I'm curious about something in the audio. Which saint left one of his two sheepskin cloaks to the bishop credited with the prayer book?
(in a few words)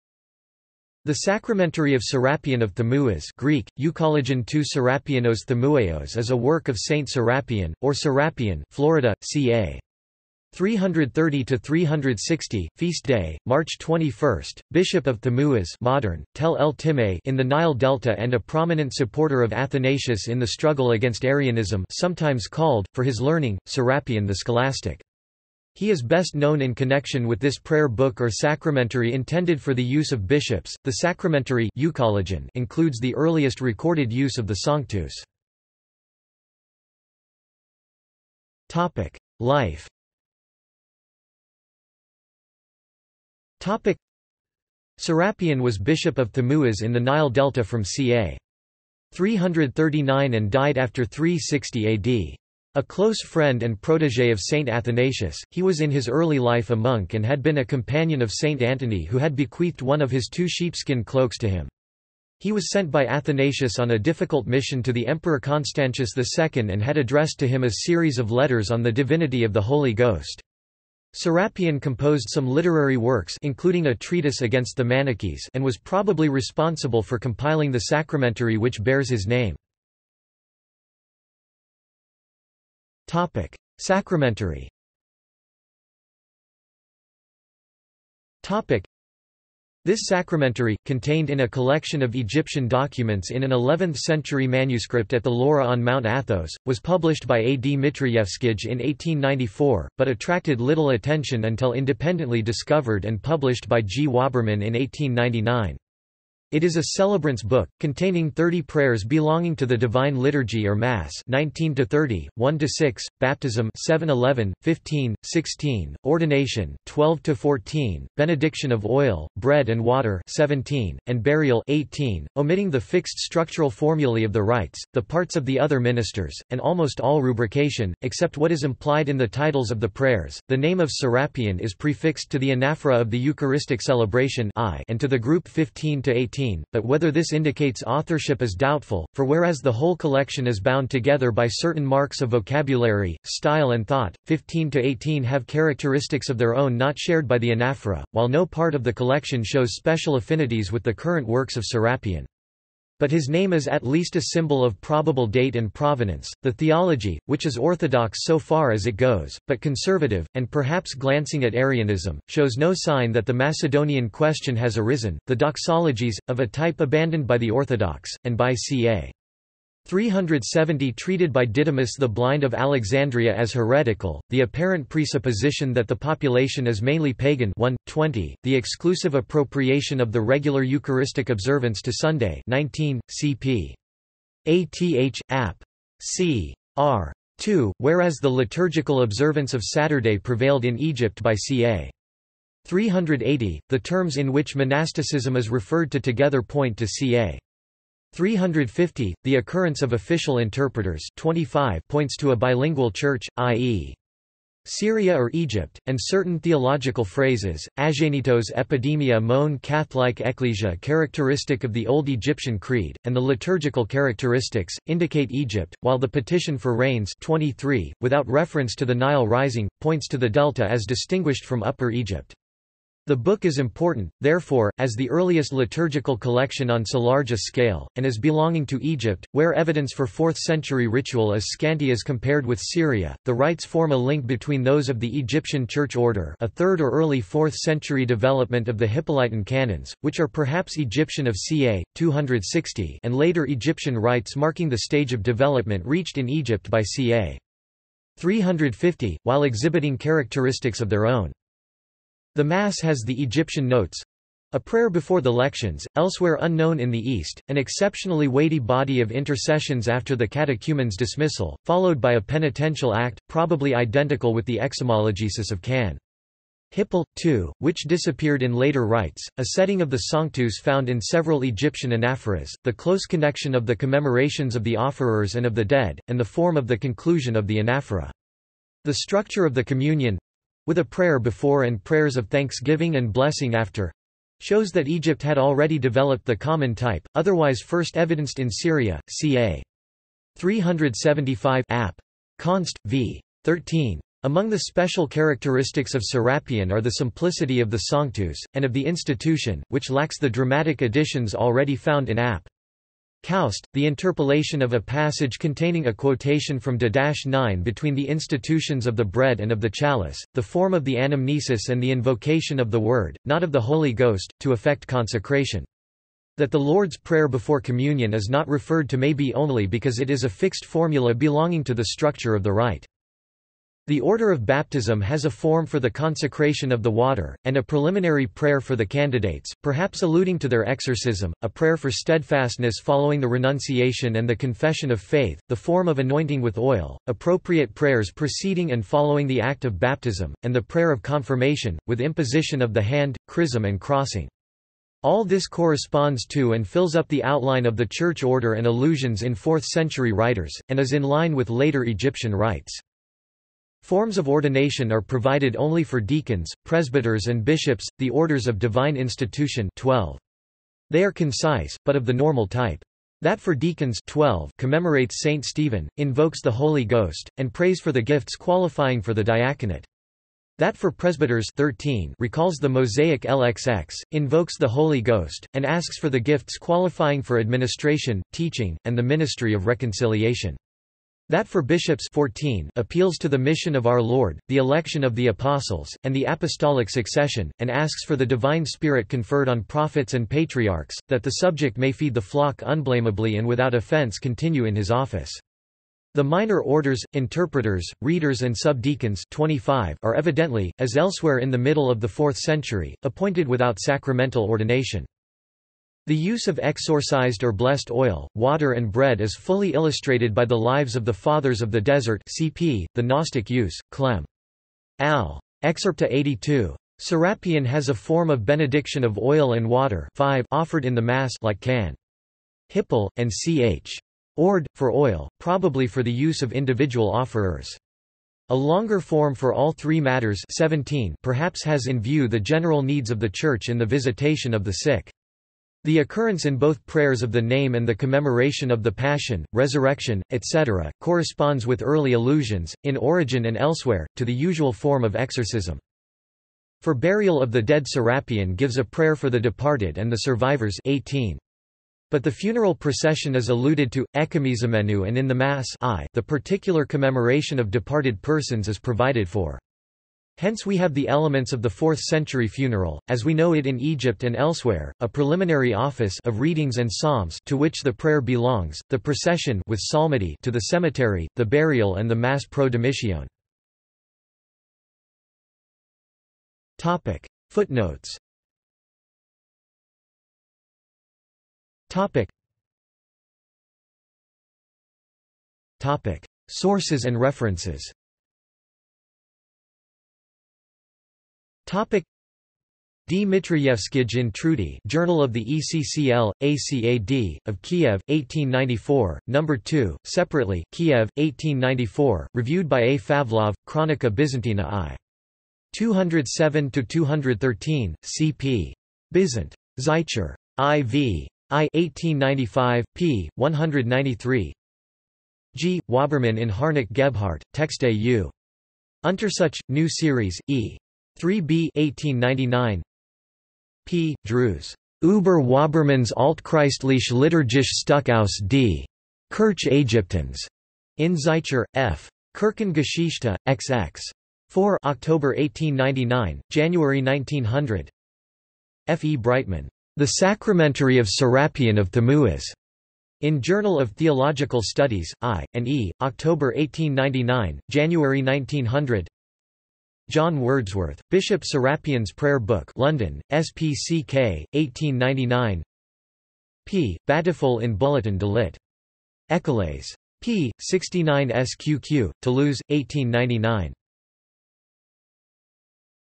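Antony.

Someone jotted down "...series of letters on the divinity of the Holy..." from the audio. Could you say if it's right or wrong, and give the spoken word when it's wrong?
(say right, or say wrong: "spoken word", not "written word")
right.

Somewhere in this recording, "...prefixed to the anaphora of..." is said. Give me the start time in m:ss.
2:11.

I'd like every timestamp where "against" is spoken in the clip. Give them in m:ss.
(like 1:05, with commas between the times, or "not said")
0:20, 1:14.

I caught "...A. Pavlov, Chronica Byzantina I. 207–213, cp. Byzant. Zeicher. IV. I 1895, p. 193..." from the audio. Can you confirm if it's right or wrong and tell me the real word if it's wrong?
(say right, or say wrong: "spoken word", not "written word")
right.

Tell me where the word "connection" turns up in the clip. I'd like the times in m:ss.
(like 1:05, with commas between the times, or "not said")
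0:26, 4:33.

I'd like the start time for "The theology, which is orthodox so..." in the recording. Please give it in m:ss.
2:36.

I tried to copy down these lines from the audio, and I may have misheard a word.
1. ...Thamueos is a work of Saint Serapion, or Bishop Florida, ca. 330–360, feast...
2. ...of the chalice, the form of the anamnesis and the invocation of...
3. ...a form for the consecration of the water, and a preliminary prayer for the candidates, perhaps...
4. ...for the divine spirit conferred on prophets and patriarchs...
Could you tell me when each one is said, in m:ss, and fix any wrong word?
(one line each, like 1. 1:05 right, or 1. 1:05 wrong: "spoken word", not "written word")
1. 0:05 wrong: "Serapion", not "Bishop"
2. 5:09 right
3. 5:25 right
4. 6:28 right.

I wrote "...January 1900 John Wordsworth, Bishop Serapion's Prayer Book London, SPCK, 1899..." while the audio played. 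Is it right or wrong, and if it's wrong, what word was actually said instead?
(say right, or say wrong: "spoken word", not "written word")
right.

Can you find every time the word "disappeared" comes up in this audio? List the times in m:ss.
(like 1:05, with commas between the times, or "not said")
4:27.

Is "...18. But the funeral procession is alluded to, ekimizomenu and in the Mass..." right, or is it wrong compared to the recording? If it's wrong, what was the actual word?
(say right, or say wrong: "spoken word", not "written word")
right.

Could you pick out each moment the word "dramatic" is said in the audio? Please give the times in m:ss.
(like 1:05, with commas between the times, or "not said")
5:00.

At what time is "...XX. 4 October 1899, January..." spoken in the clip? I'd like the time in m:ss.
8:53.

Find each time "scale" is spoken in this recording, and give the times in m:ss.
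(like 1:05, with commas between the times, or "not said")
3:47.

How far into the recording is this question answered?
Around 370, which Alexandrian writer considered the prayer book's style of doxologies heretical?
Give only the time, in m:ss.
2:51.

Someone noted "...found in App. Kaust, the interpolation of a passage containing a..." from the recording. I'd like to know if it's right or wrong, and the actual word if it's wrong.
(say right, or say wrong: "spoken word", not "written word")
right.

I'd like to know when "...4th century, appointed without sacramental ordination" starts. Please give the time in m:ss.
6:42.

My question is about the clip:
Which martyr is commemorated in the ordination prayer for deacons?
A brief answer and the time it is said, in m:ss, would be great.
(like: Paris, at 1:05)
St. Stephen, at 6:05.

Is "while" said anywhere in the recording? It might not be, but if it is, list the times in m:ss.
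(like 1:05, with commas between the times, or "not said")
2:28, 3:35, 4:09.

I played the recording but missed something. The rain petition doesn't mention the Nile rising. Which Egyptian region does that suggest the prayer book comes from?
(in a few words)
the delta.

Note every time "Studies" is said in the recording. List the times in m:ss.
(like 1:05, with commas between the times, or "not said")
9:04.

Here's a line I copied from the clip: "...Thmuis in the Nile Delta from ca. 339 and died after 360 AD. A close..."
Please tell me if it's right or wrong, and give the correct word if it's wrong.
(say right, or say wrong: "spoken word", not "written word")
right.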